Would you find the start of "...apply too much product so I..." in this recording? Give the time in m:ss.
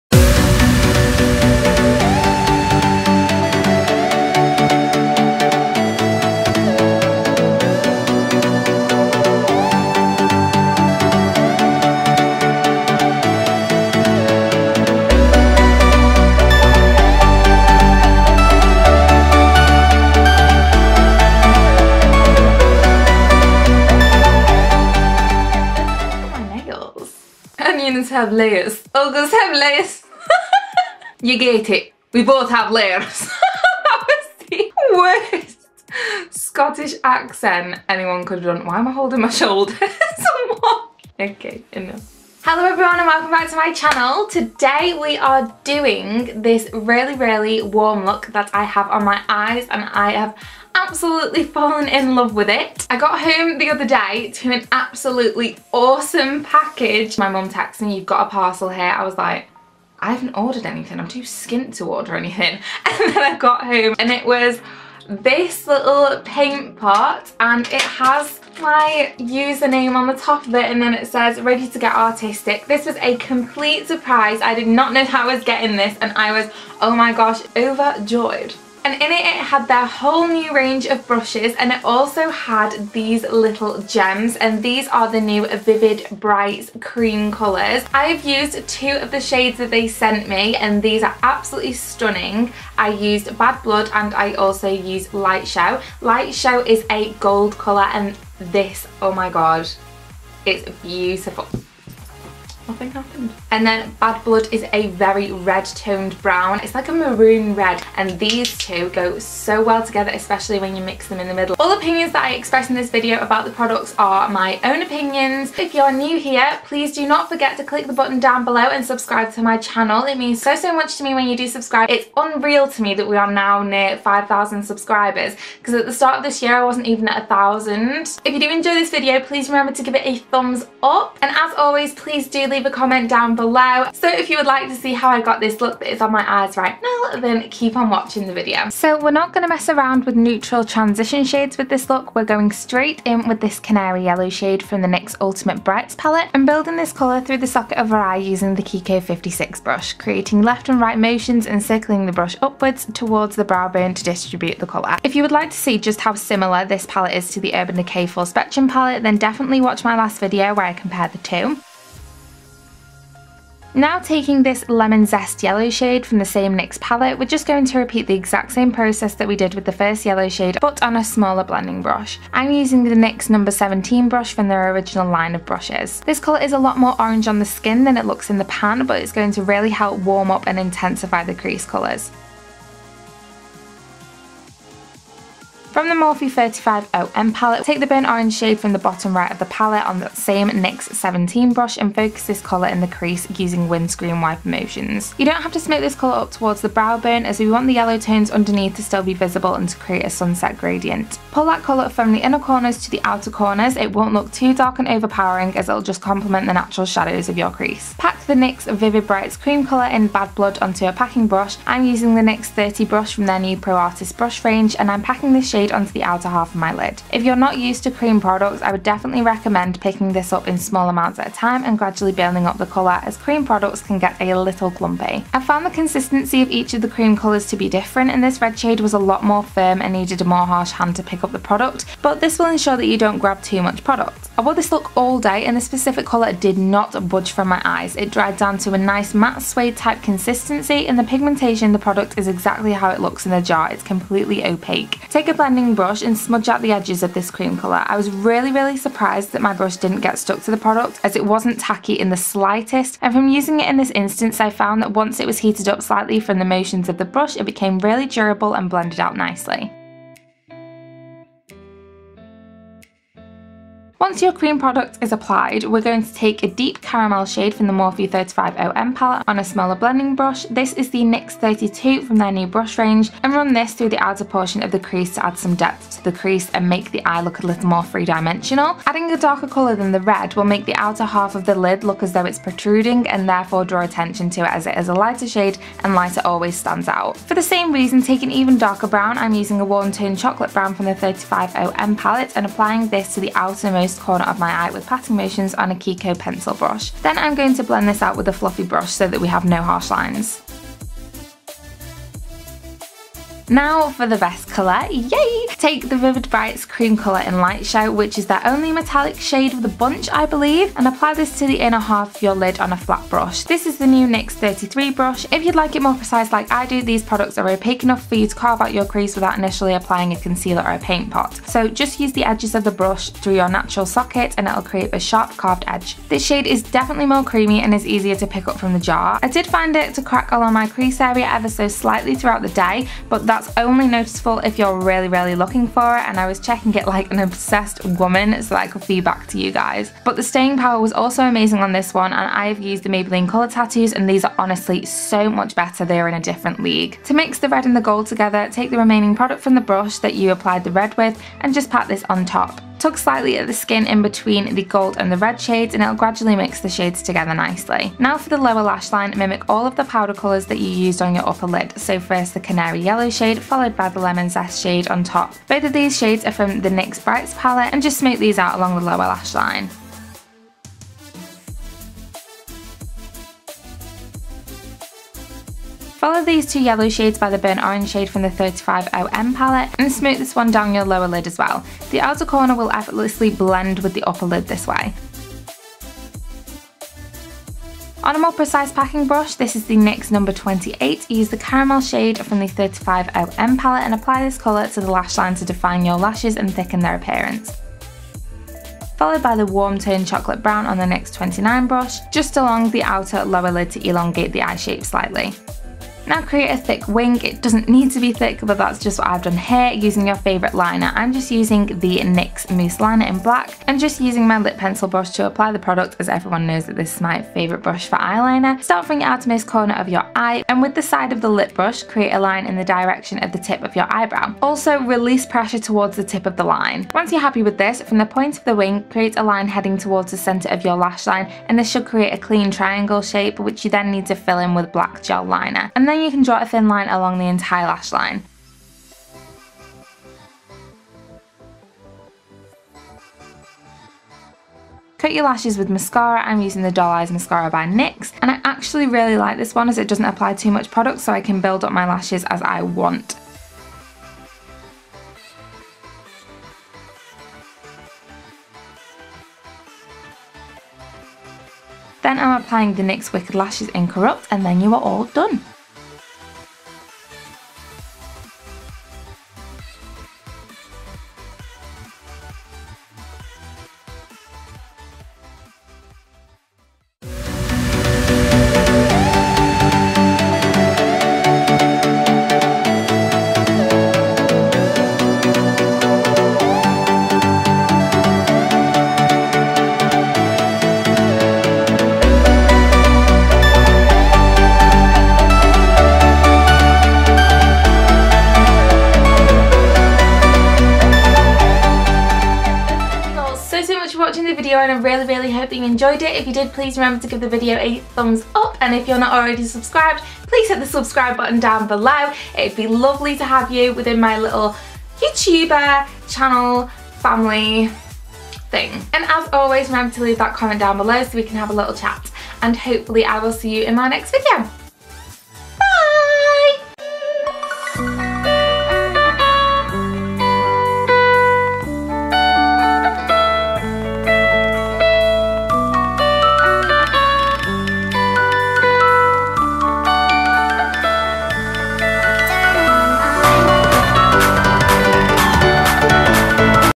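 7:30.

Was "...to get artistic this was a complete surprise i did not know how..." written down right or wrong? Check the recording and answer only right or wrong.
right.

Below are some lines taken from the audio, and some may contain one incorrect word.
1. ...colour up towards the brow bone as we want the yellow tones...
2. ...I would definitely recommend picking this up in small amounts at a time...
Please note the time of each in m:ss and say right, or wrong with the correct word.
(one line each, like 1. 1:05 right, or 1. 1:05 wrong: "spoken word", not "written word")
1. 3:15 right
2. 3:38 right.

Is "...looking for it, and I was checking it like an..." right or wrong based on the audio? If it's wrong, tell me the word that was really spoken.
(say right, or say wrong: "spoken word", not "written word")
right.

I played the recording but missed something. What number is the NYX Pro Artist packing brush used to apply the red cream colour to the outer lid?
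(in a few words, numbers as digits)
30.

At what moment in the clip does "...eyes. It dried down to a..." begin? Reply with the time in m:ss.
3:57.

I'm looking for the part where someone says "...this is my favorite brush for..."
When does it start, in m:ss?
6:56.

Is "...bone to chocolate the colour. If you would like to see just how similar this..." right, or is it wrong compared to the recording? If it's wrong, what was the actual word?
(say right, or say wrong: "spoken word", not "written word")
wrong: "distribute", not "chocolate".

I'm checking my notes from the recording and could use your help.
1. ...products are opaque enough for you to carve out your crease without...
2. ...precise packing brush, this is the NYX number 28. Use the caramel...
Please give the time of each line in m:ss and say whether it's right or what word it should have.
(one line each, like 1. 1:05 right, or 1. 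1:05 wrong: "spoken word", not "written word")
1. 5:17 right
2. 6:28 right.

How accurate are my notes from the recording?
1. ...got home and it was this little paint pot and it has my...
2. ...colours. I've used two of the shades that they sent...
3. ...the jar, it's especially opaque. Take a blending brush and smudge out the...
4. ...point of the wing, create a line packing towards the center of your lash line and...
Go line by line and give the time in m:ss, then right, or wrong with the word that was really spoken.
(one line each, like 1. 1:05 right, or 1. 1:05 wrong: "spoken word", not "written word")
1. 1:03 right
2. 1:27 right
3. 4:03 wrong: "completely", not "especially"
4. 7:08 wrong: "heading", not "packing".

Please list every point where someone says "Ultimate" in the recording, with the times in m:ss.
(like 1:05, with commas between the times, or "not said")
2:25.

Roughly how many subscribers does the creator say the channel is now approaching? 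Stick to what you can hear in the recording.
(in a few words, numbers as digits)
5,000.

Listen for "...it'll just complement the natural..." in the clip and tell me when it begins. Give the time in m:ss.
3:25.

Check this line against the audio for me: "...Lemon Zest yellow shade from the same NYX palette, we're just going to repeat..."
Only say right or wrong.
right.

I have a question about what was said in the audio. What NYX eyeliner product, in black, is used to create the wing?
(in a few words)
Mousse Liner.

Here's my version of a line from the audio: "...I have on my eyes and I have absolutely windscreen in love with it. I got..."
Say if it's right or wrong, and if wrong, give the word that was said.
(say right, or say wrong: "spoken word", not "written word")
wrong: "fallen", not "windscreen".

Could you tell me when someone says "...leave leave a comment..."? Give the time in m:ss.
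2:12.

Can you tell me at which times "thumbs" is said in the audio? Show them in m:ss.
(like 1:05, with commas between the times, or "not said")
2:10, 8:27.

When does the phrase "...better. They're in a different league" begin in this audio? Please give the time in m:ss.
5:45.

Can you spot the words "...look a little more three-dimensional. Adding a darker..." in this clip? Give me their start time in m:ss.
4:37.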